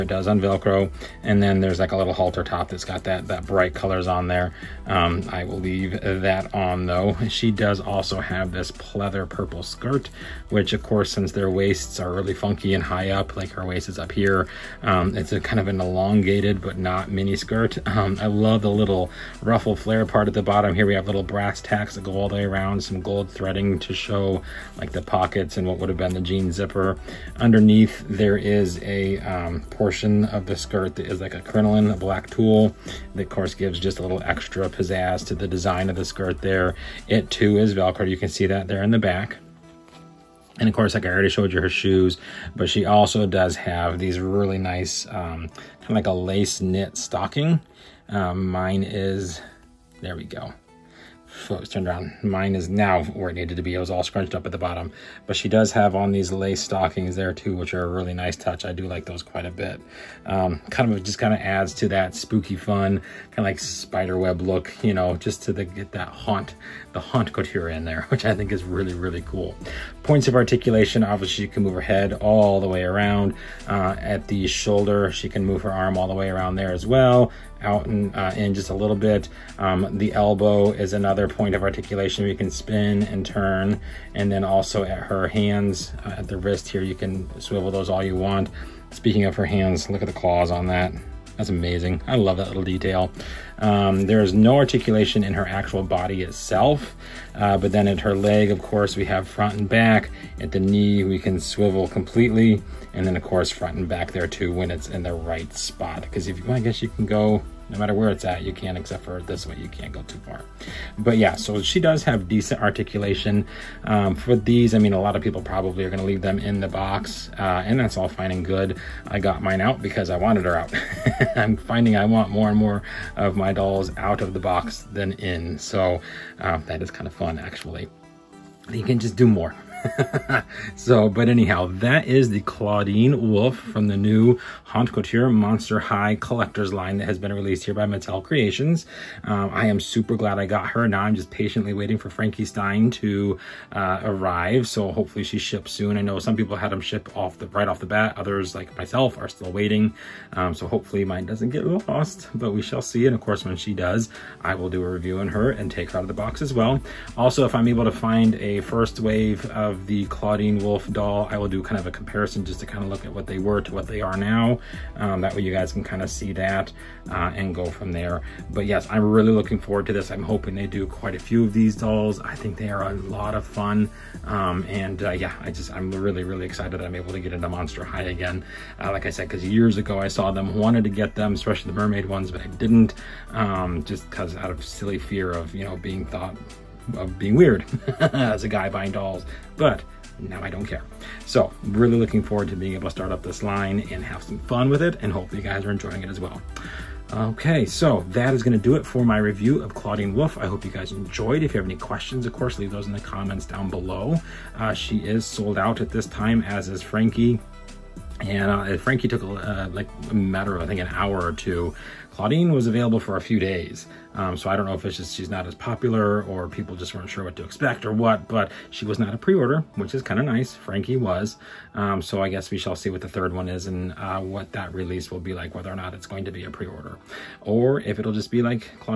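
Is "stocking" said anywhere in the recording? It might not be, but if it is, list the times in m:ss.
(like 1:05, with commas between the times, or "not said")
0:46, 0:56.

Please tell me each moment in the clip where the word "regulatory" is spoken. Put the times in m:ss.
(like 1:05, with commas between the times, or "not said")
not said.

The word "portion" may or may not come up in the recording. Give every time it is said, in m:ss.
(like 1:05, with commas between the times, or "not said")
0:29.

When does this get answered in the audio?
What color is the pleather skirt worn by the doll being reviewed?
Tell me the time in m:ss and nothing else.
0:09.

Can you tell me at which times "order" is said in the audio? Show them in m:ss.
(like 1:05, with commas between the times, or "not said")
3:39, 3:46.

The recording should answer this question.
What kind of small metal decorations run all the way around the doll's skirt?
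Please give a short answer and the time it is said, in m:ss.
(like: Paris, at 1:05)
Brass tacks, at 0:21.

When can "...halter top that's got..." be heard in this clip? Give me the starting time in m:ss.
0:02.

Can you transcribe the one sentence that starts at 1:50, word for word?
But yeah, so she does have decent articulation.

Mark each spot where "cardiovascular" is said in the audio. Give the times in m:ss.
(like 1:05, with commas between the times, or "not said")
not said.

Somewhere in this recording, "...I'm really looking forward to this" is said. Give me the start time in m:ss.
2:48.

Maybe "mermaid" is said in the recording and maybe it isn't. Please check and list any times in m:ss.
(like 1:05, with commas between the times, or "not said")
3:01.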